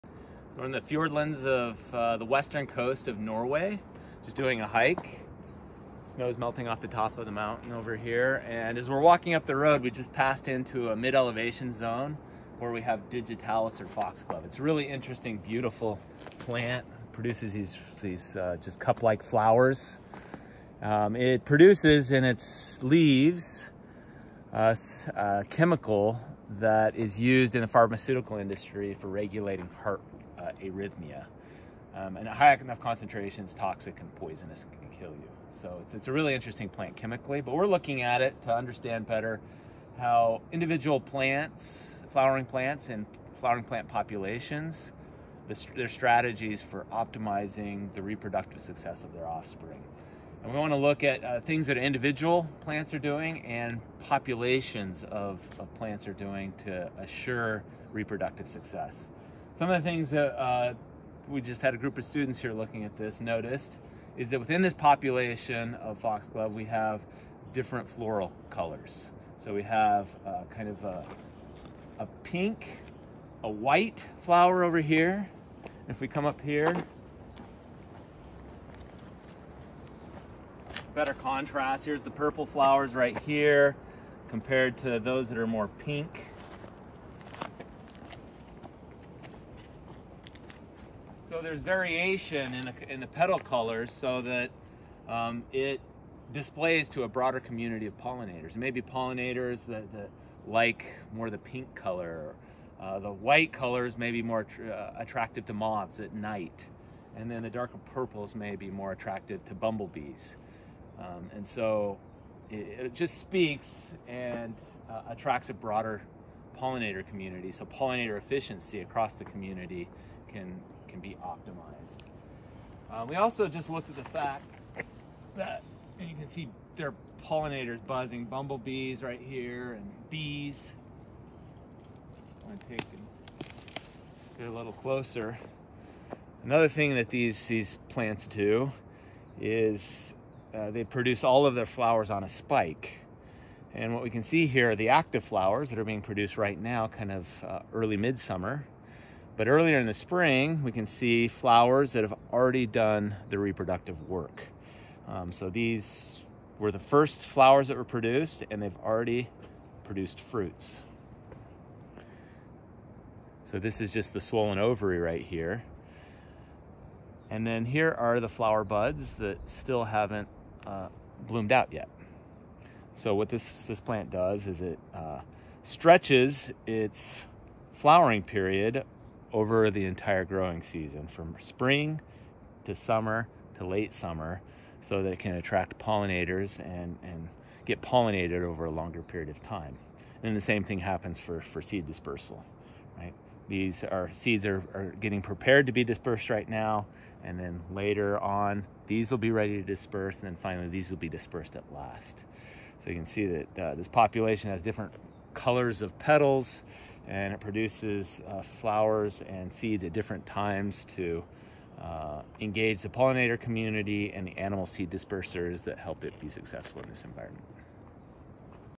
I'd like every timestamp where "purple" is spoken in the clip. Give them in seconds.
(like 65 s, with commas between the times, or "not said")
82 s, 107 s.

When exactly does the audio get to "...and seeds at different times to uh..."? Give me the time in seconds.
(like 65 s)
209 s.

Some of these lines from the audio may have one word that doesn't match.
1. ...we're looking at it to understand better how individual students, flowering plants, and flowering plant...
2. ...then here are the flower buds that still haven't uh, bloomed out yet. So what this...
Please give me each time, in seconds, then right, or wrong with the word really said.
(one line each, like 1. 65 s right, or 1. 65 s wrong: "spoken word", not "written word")
1. 37 s wrong: "plants", not "students"
2. 167 s right.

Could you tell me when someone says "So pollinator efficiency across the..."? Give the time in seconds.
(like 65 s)
117 s.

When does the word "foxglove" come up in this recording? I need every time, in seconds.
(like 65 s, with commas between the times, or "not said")
13 s, 65 s.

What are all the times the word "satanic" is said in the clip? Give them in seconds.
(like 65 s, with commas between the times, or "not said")
not said.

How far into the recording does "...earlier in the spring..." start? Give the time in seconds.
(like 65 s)
149 s.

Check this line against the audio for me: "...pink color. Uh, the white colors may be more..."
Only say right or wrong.
right.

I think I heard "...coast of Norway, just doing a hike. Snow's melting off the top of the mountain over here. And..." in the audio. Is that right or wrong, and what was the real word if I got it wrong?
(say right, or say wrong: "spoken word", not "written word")
right.